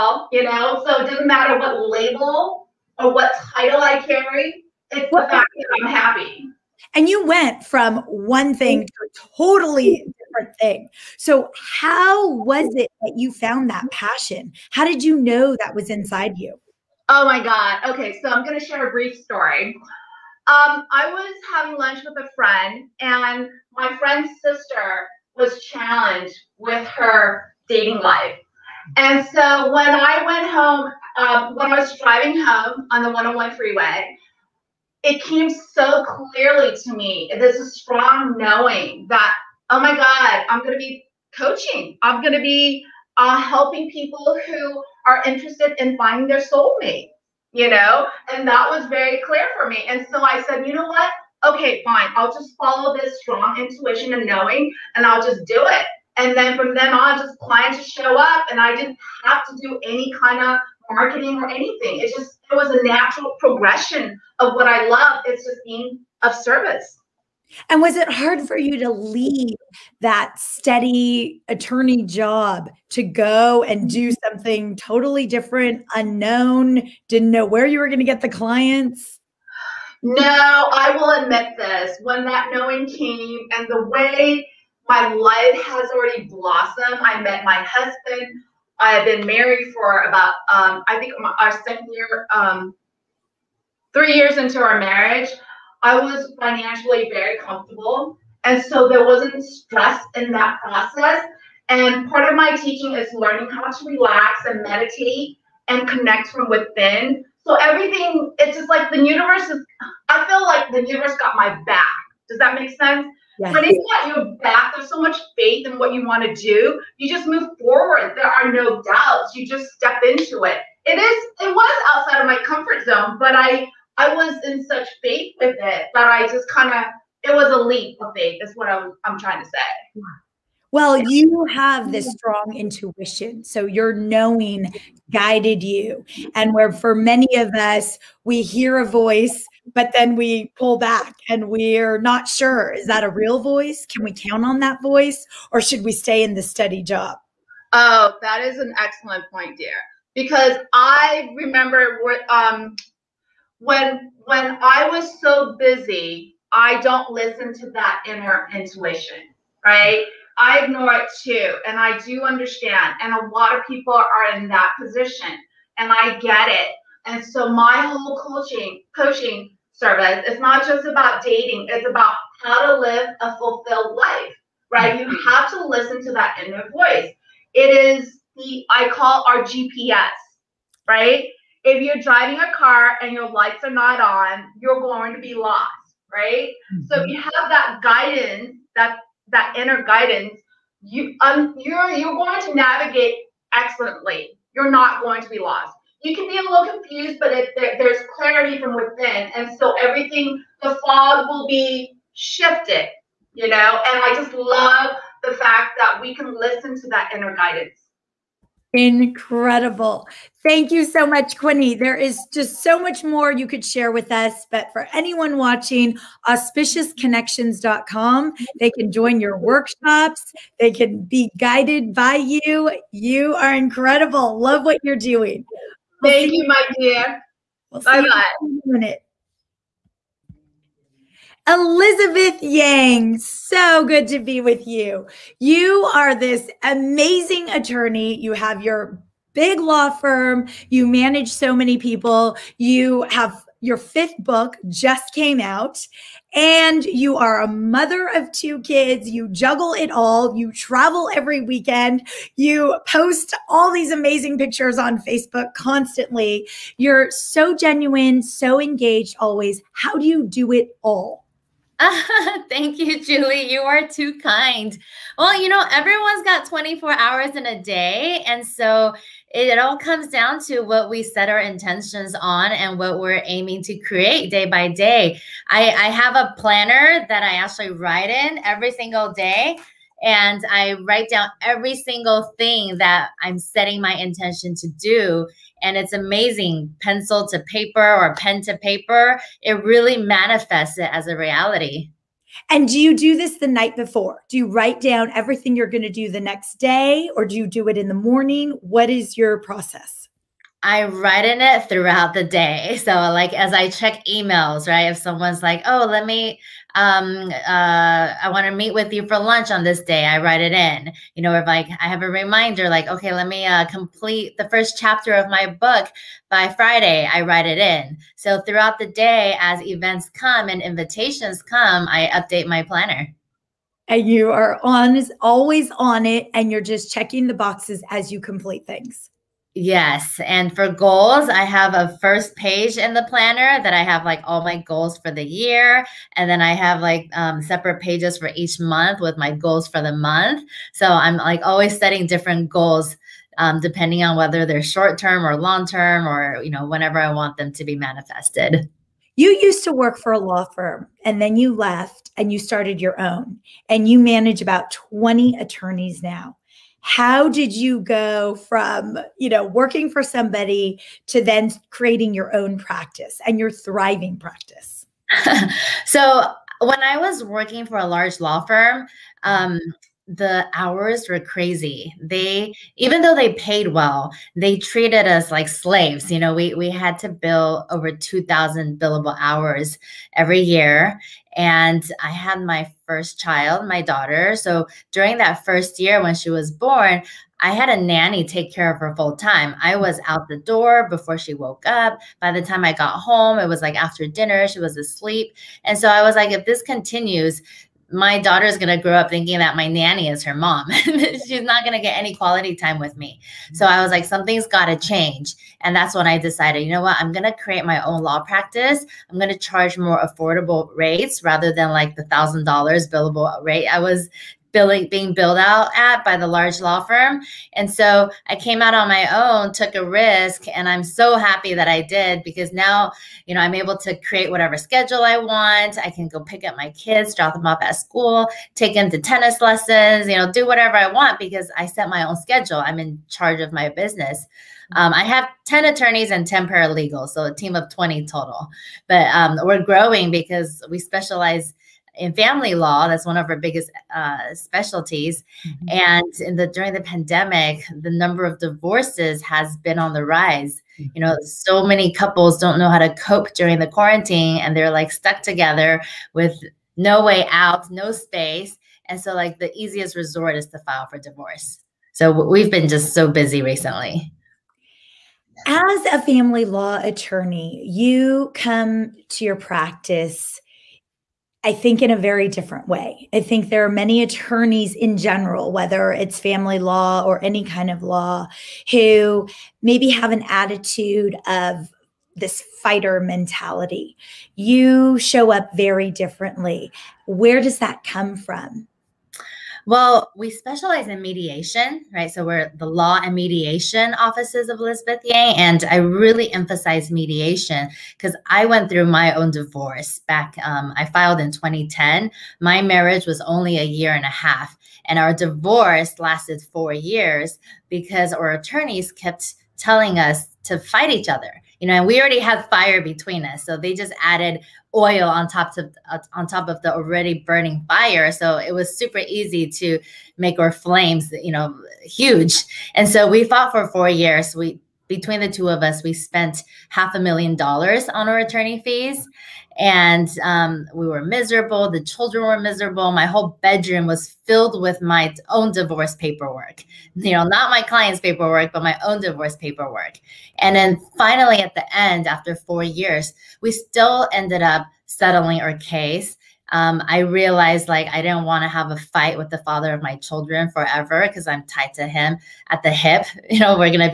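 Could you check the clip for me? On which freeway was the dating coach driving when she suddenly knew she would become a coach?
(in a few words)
101 freeway.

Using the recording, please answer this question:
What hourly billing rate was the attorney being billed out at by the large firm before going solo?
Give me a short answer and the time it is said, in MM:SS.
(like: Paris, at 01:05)
$1,000, at 06:52.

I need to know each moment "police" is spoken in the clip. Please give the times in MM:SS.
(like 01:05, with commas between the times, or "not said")
not said.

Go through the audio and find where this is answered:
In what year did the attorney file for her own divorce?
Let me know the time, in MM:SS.
08:21.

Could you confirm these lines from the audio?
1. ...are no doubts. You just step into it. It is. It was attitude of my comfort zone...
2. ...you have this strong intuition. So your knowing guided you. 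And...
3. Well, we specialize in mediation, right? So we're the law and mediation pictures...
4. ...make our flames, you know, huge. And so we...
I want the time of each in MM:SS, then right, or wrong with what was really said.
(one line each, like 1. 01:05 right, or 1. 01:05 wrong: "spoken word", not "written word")
1. 01:58 wrong: "outside", not "attitude"
2. 02:10 right
3. 08:09 wrong: "offices", not "pictures"
4. 08:40 right.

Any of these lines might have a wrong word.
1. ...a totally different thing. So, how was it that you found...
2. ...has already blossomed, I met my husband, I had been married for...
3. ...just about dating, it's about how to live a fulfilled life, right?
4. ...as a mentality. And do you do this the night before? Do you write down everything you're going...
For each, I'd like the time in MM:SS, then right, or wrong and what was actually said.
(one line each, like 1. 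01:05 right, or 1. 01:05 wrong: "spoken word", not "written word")
1. 00:09 right
2. 01:25 right
3. 02:50 right
4. 04:50 wrong: "reality", not "mentality".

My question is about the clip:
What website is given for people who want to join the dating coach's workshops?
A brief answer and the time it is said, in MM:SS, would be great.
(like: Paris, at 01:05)
auspiciousconnections.com, at 03:36.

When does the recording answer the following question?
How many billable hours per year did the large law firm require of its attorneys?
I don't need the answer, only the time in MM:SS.
06:17.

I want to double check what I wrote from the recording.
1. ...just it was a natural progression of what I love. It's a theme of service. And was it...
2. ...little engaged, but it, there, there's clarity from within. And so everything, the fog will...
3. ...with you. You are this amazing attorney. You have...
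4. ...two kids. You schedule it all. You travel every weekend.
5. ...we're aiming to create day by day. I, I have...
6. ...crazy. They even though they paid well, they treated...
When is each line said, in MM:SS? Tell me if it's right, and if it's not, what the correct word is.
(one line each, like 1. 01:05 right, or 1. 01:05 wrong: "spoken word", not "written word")
1. 01:02 right
2. 03:16 wrong: "confused", not "engaged"
3. 03:54 right
4. 04:08 wrong: "juggle", not "schedule"
5. 04:32 right
6. 06:11 right.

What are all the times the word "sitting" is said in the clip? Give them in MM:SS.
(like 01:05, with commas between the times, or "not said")
not said.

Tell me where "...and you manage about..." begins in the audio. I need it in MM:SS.
05:53.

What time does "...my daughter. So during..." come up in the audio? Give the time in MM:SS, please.
06:23.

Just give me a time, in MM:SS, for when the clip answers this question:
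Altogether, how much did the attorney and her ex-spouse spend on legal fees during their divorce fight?
08:46.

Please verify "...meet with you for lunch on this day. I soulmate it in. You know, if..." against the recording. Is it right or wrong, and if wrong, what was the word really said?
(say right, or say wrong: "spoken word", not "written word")
wrong: "write", not "soulmate".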